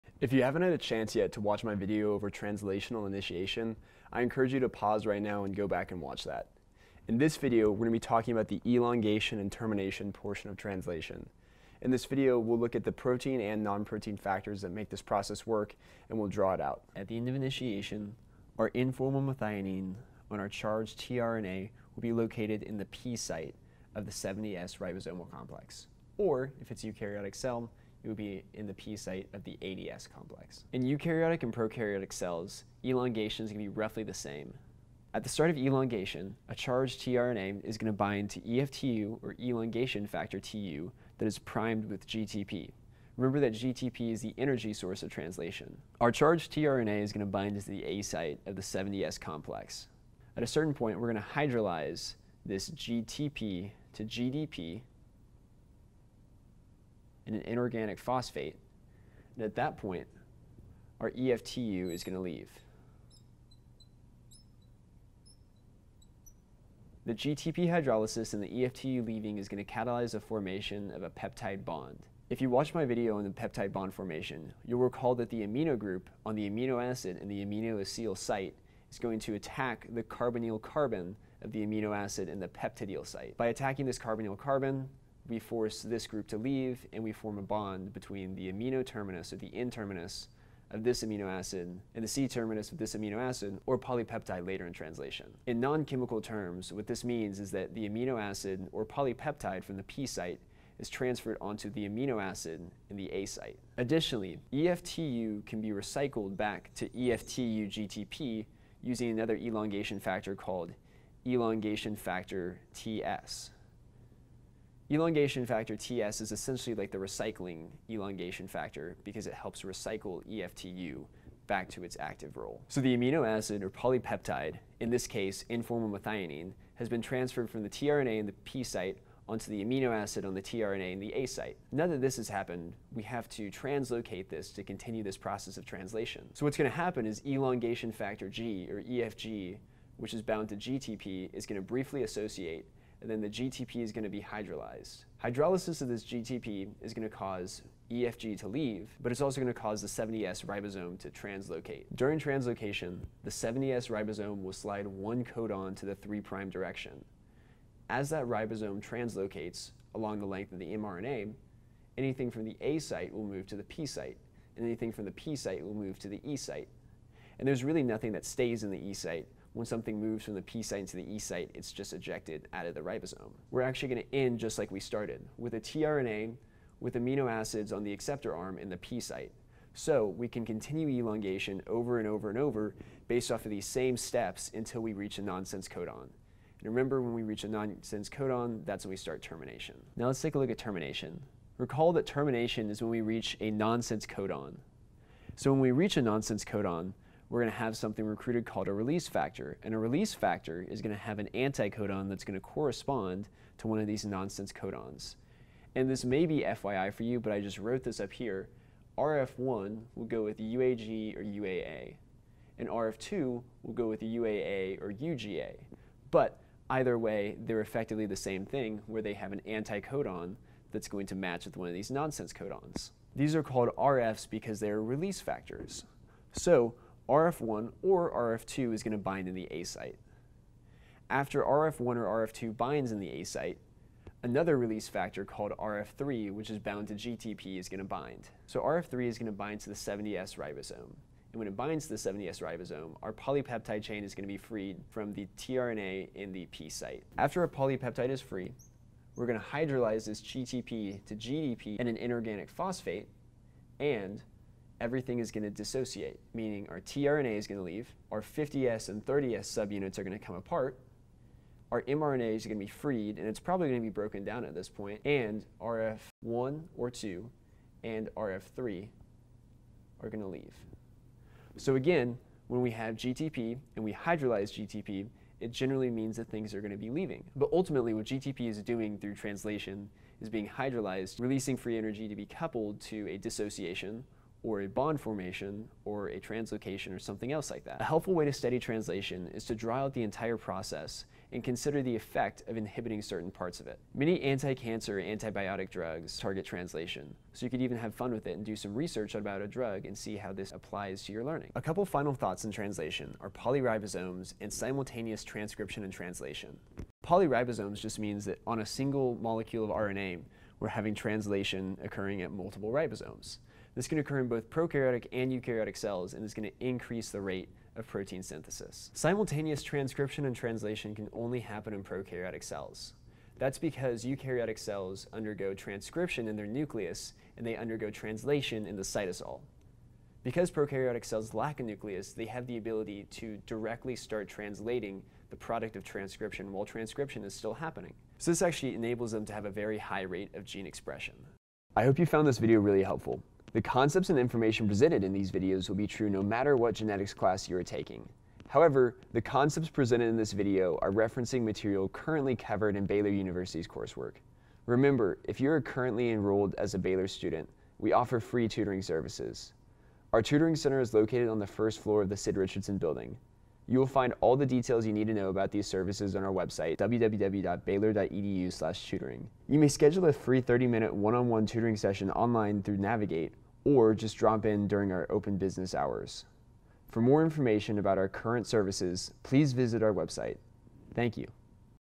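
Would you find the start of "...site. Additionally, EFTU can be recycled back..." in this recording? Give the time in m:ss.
1:43.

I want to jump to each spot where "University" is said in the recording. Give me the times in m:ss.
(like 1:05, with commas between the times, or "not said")
5:53.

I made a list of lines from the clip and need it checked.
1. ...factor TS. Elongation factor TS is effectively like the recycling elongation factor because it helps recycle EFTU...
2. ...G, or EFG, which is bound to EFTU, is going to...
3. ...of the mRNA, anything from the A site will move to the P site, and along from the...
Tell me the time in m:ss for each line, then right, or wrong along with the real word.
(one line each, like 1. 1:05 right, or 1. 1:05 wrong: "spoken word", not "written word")
1. 1:51 wrong: "essentially", not "effectively"
2. 2:18 wrong: "GTP", not "EFTU"
3. 2:40 wrong: "anything", not "along".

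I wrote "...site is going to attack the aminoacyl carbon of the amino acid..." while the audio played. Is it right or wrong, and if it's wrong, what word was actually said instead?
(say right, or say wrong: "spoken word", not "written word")
wrong: "carbonyl", not "aminoacyl".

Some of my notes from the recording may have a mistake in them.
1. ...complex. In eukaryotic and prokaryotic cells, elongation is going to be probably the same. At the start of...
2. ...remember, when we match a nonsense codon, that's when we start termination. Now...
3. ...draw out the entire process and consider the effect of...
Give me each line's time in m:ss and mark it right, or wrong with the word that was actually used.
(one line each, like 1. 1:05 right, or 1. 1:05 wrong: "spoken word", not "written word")
1. 0:30 wrong: "roughly", not "probably"
2. 3:06 wrong: "reach", not "match"
3. 4:49 right.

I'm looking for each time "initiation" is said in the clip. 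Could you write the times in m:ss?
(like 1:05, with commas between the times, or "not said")
0:03, 0:17.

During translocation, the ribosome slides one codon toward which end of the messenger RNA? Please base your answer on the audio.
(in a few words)
3' direction.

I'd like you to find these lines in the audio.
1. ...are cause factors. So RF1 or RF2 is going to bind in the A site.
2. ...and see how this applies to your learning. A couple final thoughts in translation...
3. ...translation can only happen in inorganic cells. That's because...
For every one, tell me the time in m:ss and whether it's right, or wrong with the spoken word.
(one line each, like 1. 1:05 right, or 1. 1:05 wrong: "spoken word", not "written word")
1. 3:44 wrong: "release", not "cause"
2. 4:59 right
3. 5:20 wrong: "prokaryotic", not "inorganic".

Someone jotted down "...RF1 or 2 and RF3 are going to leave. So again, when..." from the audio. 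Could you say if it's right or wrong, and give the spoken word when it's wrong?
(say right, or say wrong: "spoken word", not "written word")
right.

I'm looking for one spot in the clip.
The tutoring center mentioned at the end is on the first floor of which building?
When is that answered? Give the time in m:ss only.
6:02.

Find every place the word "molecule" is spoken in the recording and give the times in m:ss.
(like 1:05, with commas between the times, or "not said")
5:09.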